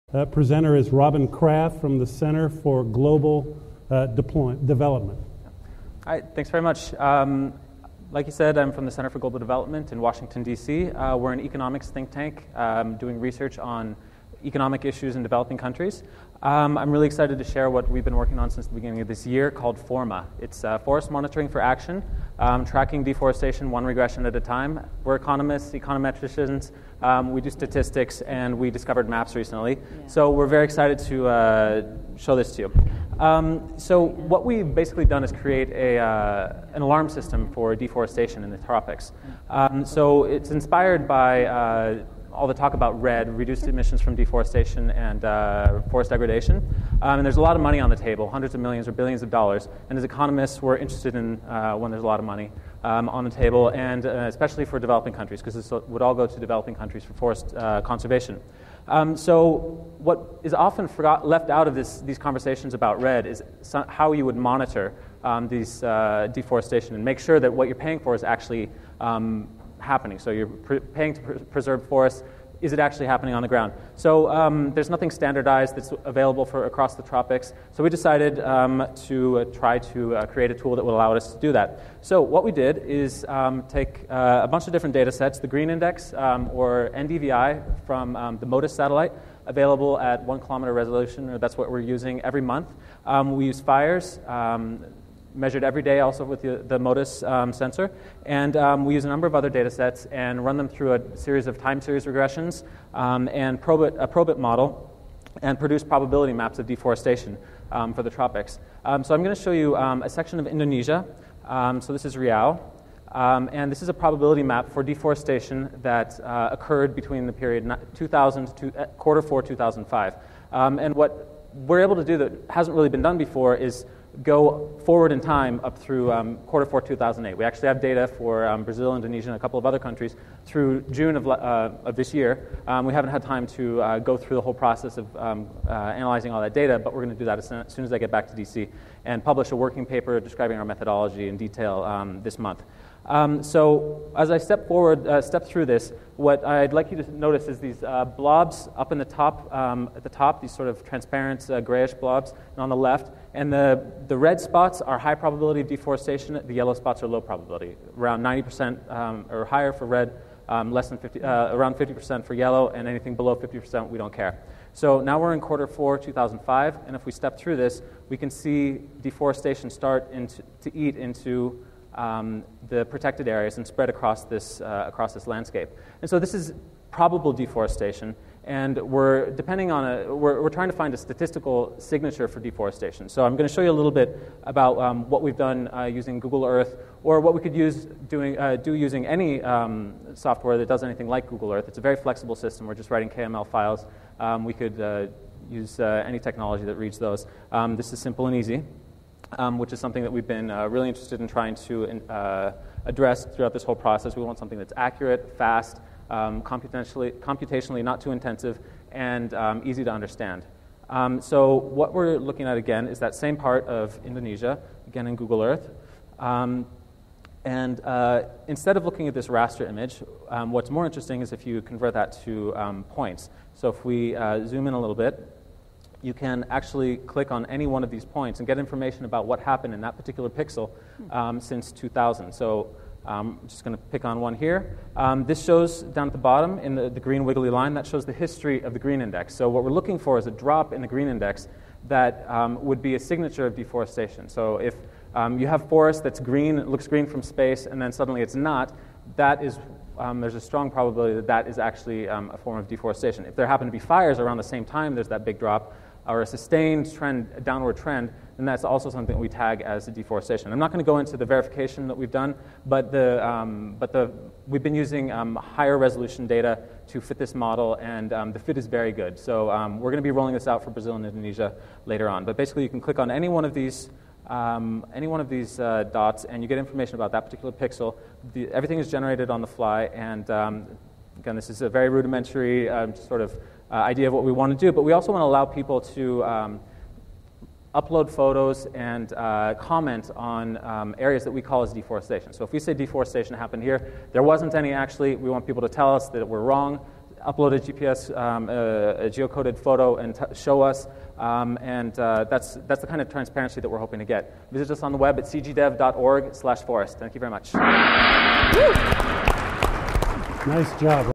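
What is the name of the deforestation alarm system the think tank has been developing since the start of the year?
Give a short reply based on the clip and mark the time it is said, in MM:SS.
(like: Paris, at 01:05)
FORMA, at 00:19.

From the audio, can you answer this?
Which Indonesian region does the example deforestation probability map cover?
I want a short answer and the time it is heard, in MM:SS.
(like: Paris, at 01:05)
Riau, at 01:52.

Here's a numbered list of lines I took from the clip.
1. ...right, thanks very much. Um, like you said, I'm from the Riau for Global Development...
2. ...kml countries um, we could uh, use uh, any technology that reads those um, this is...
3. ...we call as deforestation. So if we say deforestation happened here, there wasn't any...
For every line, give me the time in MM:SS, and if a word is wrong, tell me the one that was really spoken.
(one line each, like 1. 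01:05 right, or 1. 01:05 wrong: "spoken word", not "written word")
1. 00:06 wrong: "Center", not "Riau"
2. 03:13 wrong: "files", not "countries"
3. 04:51 right.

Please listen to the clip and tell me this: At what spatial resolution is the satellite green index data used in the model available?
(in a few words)
1 kilometer.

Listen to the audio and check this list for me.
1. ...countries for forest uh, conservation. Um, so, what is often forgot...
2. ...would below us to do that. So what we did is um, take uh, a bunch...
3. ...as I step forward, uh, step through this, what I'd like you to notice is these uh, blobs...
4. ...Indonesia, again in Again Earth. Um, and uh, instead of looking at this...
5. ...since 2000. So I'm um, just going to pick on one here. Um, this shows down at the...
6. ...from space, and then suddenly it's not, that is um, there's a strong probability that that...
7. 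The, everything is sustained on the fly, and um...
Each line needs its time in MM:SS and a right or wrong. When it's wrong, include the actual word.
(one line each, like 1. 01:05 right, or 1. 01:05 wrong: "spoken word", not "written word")
1. 00:56 right
2. 01:20 wrong: "allow", not "below"
3. 02:24 right
4. 03:34 wrong: "Google", not "Again"
5. 03:51 right
6. 04:07 right
7. 04:38 wrong: "generated", not "sustained".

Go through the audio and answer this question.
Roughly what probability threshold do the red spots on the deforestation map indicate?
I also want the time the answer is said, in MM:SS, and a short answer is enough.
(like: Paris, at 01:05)
90%, at 02:38.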